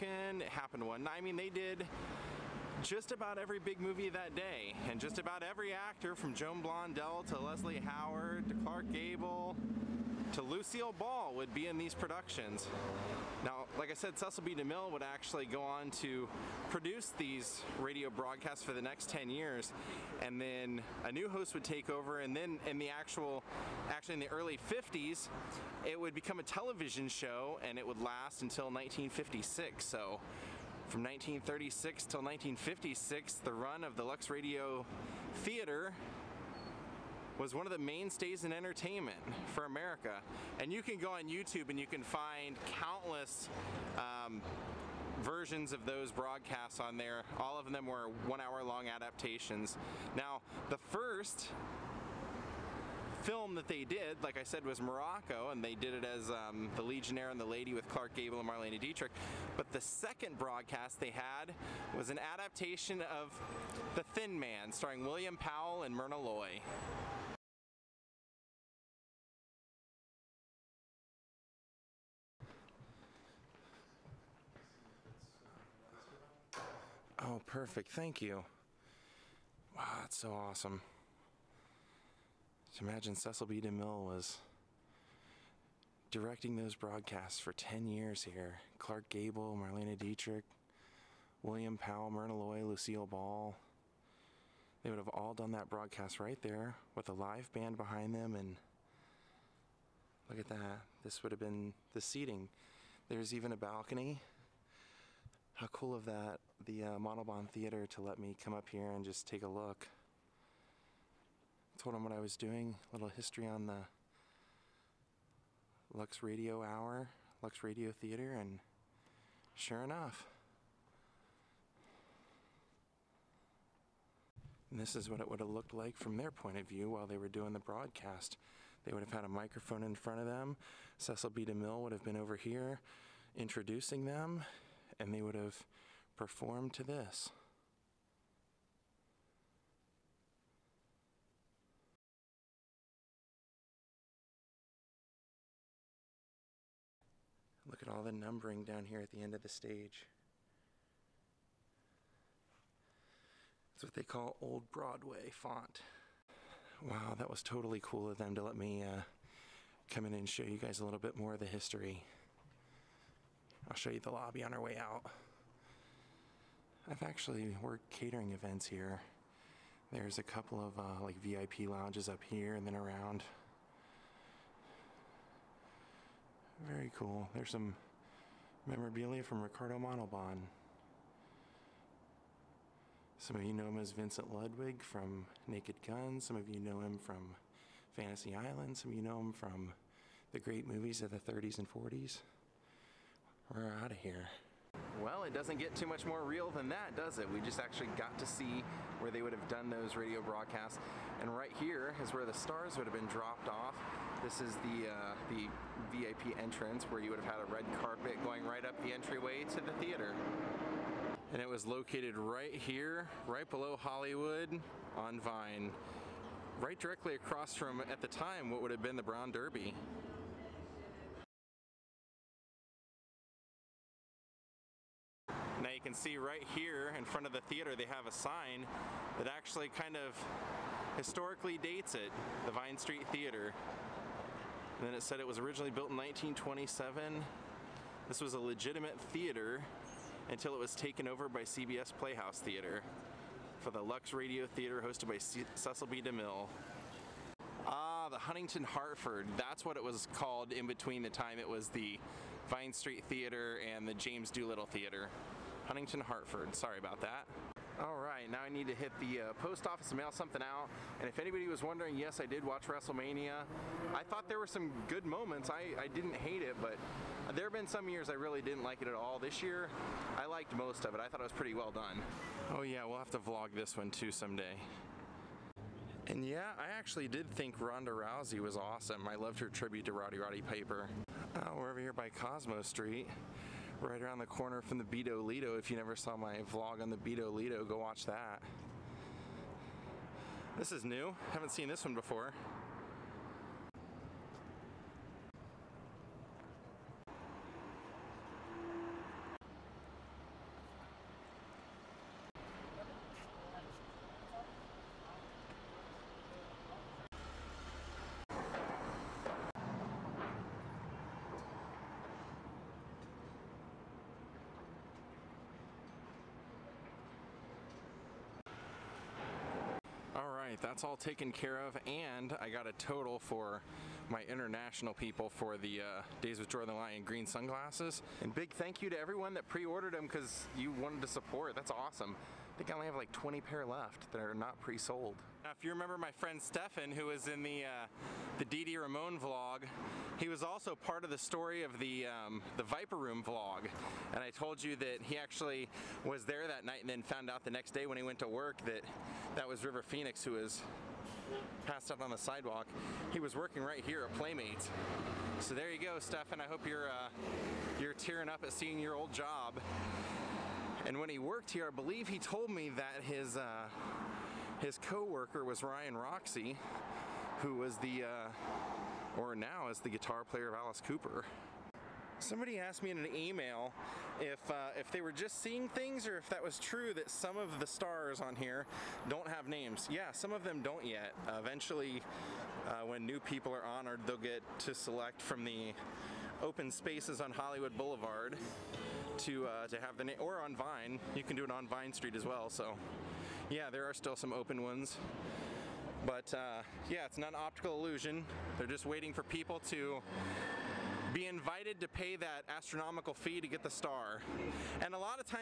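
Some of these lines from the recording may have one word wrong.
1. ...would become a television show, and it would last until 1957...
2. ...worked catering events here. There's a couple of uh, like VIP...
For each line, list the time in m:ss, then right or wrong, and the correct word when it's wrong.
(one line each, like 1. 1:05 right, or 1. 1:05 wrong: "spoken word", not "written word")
1. 0:25 wrong: "1956", not "1957"
2. 2:47 right.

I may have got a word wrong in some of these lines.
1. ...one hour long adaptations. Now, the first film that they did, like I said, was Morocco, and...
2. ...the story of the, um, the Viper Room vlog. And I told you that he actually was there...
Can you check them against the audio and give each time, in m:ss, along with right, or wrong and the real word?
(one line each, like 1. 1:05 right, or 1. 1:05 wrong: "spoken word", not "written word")
1. 0:48 right
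2. 5:41 right.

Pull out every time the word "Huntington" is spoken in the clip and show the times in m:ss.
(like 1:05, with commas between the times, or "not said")
4:08, 4:15.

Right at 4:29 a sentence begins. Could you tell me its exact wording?
This year, I liked most of it.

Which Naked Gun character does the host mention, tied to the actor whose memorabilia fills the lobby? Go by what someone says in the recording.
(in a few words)
Vincent Ludwig.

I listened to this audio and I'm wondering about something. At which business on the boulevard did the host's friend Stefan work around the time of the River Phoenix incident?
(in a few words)
Playmates.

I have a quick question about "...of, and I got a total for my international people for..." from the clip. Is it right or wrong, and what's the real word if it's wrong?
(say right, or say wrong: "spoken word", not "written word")
right.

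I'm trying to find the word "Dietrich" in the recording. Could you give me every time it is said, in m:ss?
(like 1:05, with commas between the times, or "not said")
0:58, 1:29.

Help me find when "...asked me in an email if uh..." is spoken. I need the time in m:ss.
6:12.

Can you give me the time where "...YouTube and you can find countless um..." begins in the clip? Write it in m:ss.
0:41.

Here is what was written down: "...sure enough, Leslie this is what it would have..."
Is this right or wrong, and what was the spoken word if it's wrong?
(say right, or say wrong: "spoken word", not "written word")
wrong: "And", not "Leslie".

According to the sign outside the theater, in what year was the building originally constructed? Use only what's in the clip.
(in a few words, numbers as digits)
1927.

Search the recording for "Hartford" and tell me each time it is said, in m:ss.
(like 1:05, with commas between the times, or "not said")
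4:08, 4:16.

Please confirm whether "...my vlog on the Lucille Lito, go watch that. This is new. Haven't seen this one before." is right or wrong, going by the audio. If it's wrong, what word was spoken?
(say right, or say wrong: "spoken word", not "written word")
wrong: "Bido", not "Lucille".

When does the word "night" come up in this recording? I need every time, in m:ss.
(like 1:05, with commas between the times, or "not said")
0:01, 5:46.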